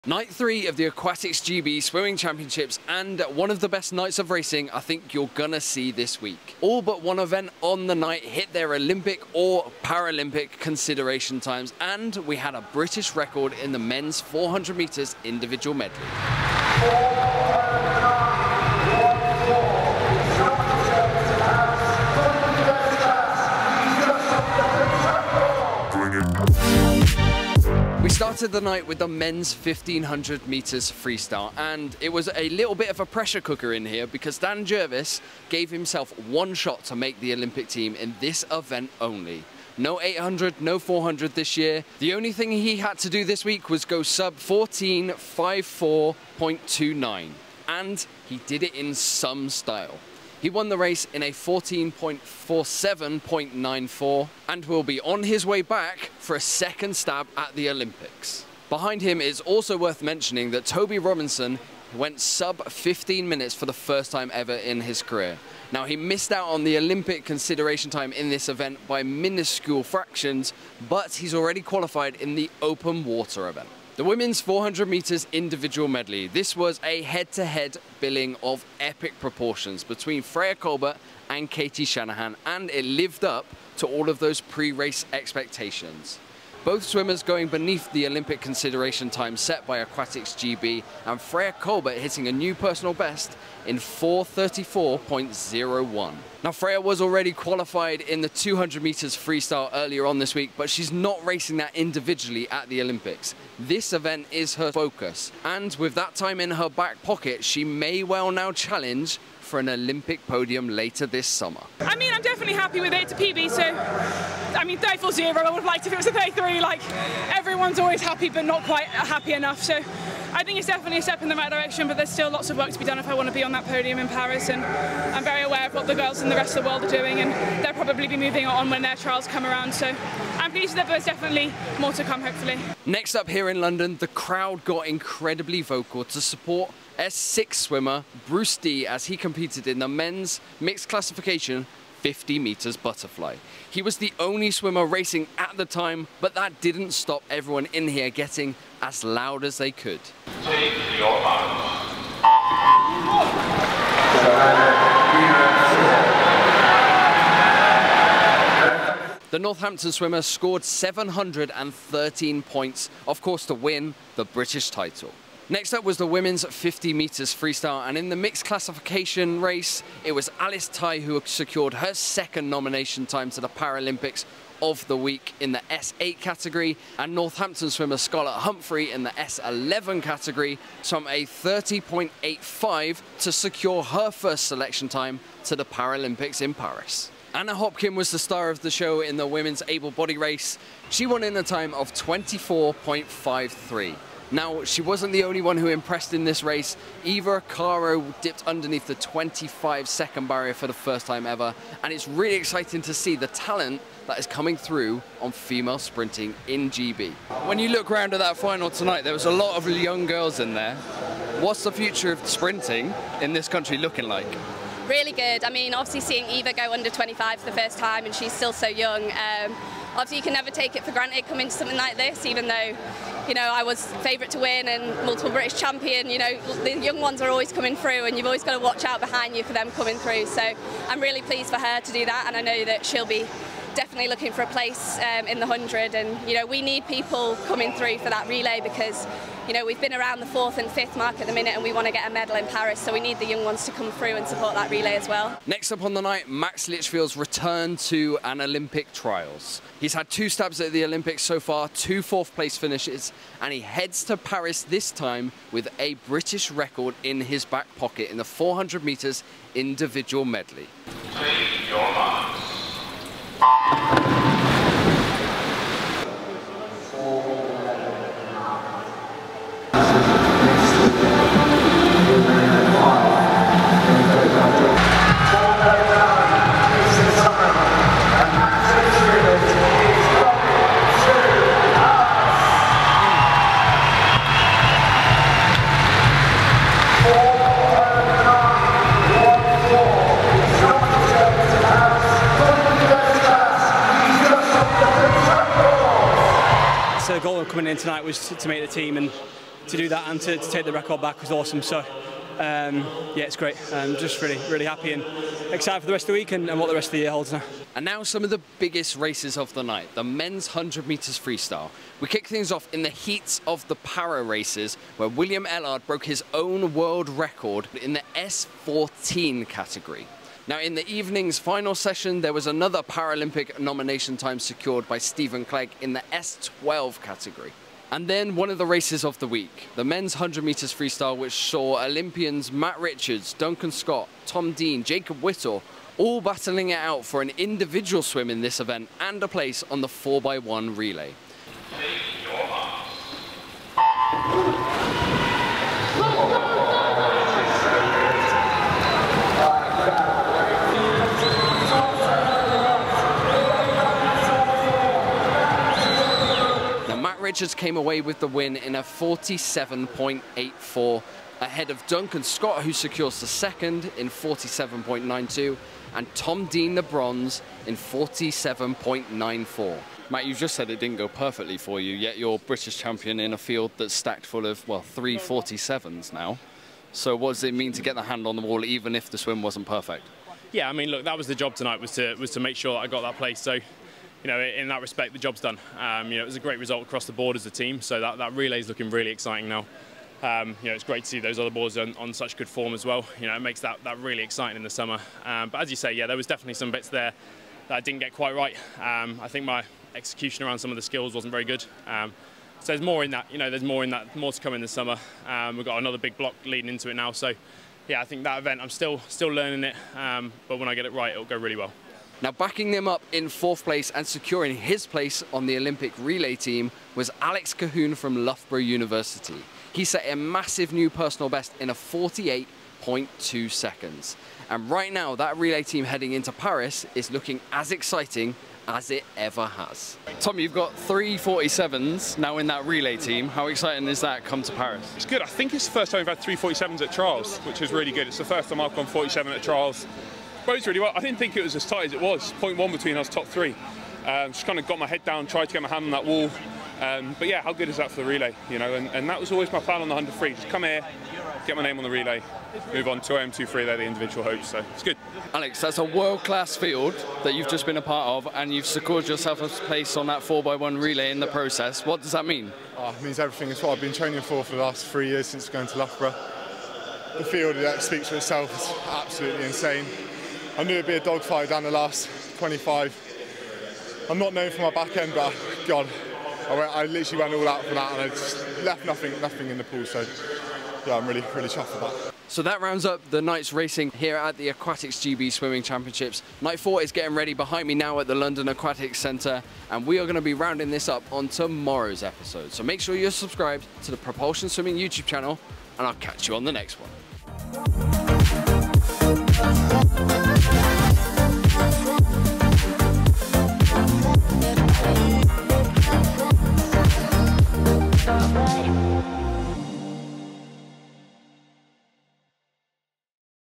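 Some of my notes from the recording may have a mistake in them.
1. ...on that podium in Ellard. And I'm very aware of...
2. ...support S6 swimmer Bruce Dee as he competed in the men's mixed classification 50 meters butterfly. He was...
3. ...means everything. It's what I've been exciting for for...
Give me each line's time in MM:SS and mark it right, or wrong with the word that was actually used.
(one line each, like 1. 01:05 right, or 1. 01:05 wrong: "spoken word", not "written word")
1. 02:03 wrong: "Paris", not "Ellard"
2. 02:16 right
3. 07:43 wrong: "training", not "exciting".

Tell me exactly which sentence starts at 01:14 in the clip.
The women's 400 metres individual medley.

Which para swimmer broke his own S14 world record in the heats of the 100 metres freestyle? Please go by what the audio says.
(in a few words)
William Ellard.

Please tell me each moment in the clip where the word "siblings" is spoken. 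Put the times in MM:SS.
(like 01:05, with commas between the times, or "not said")
not said.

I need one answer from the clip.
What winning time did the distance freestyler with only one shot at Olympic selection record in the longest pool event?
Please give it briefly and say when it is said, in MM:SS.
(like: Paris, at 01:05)
14:47.94, at 00:51.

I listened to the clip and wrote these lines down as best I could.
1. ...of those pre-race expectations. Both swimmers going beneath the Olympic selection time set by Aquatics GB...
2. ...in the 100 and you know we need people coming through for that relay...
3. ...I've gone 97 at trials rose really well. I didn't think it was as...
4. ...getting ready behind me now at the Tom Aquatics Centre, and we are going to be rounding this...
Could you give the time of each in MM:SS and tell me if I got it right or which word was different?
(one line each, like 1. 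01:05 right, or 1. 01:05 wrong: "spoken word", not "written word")
1. 01:24 wrong: "consideration", not "selection"
2. 03:55 right
3. 07:18 wrong: "47", not "97"
4. 08:06 wrong: "London", not "Tom".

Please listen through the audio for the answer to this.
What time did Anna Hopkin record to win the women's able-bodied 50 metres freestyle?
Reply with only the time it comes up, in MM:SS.
03:11.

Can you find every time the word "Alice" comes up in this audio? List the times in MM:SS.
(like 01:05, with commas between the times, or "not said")
02:50.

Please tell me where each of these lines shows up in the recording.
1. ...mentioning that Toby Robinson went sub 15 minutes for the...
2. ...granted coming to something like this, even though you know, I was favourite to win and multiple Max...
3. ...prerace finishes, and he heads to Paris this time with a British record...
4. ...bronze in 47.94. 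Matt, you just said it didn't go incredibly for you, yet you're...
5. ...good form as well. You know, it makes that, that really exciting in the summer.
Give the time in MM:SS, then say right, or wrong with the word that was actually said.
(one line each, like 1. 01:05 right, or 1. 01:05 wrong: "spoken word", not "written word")
1. 01:00 right
2. 03:40 wrong: "British", not "Max"
3. 04:12 wrong: "place", not "prerace"
4. 06:06 wrong: "perfectly", not "incredibly"
5. 06:32 right.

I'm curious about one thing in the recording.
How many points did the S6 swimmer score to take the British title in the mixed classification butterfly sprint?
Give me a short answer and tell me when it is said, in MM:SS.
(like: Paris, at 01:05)
713, at 02:40.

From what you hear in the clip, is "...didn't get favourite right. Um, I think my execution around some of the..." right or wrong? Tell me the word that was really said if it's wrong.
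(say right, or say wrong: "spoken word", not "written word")
wrong: "quite", not "favourite".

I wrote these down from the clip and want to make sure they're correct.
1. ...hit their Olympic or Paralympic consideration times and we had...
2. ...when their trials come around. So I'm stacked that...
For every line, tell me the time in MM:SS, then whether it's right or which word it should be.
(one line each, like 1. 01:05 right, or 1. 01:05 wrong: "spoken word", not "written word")
1. 00:08 right
2. 02:08 wrong: "pleased", not "stacked".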